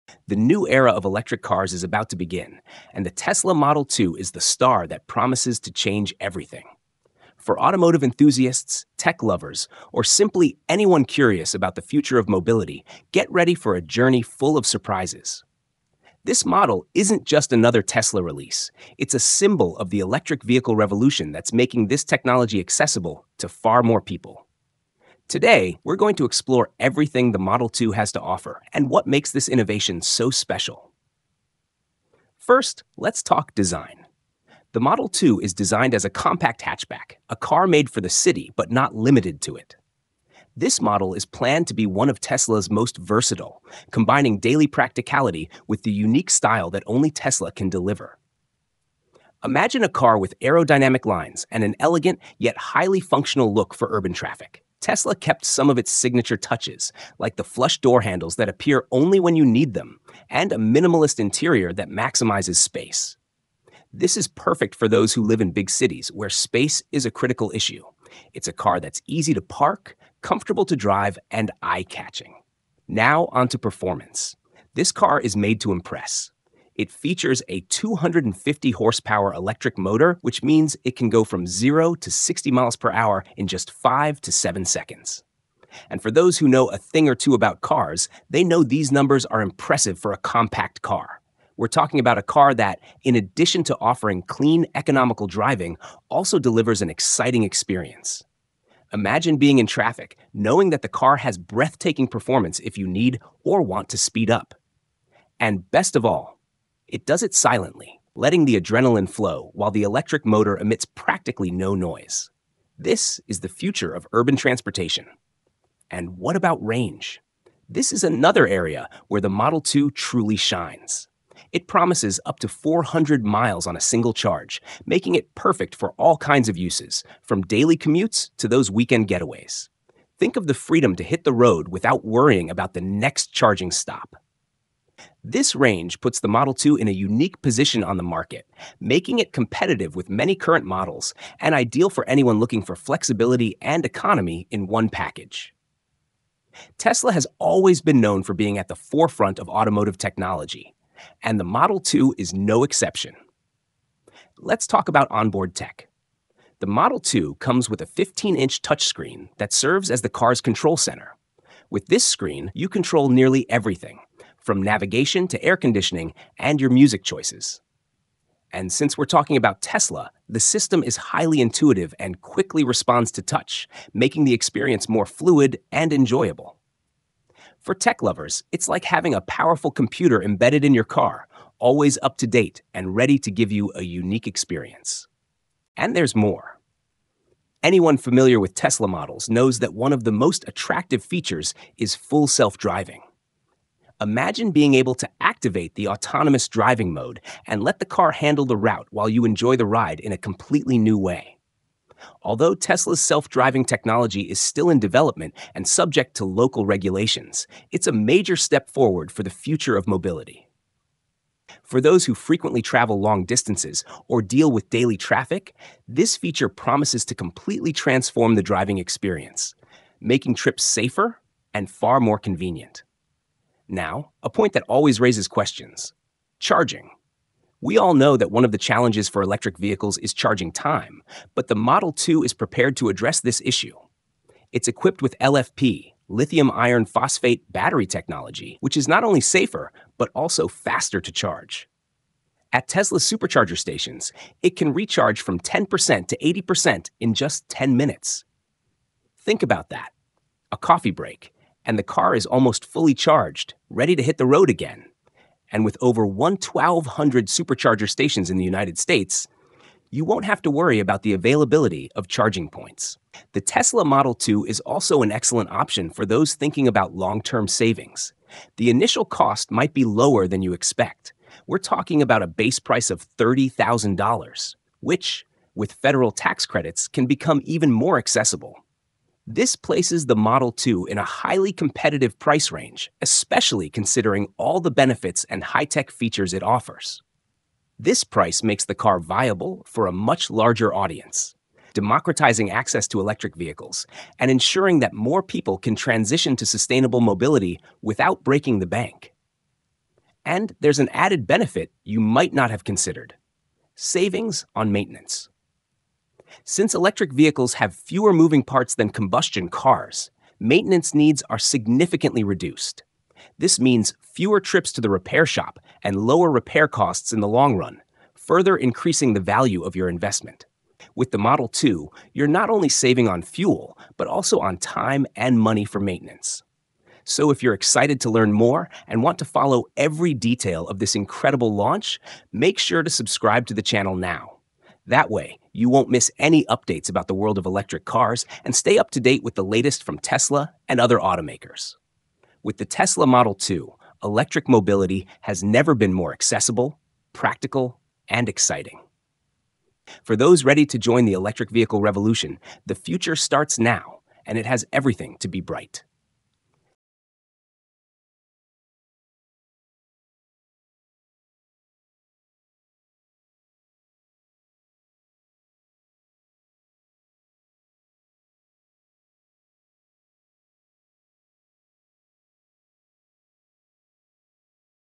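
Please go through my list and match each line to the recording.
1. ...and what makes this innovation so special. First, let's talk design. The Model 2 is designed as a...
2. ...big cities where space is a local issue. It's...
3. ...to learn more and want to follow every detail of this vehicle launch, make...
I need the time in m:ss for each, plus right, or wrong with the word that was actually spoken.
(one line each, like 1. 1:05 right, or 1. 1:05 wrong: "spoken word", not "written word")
1. 0:28 right
2. 1:05 wrong: "critical", not "local"
3. 5:28 wrong: "incredible", not "vehicle".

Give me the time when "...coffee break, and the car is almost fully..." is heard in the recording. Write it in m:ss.
4:10.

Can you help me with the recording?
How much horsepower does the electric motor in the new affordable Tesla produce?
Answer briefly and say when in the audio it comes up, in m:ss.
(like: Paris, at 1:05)
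250, at 1:17.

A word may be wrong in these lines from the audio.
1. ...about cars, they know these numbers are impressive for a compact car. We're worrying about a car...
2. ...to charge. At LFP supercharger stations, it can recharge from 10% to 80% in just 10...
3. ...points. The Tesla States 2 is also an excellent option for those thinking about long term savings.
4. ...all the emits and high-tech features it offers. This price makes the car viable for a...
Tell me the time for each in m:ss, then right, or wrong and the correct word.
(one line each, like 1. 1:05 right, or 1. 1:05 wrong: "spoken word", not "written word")
1. 1:27 wrong: "talking", not "worrying"
2. 4:00 wrong: "Tesla", not "LFP"
3. 4:22 wrong: "Model", not "States"
4. 4:44 wrong: "benefits", not "emits".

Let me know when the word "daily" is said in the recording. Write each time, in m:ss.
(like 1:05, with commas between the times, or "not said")
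0:44, 2:07, 3:34.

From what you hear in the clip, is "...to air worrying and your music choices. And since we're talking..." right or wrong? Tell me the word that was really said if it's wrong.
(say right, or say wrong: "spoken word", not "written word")
wrong: "conditioning", not "worrying".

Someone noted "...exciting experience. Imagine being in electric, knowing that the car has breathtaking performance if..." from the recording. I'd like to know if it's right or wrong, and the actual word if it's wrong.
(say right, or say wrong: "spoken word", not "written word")
wrong: "traffic", not "electric".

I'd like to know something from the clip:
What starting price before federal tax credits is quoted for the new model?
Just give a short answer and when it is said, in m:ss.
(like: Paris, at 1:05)
$30,000, at 4:33.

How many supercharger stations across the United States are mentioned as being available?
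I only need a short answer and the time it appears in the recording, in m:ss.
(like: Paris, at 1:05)
1,200, at 4:16.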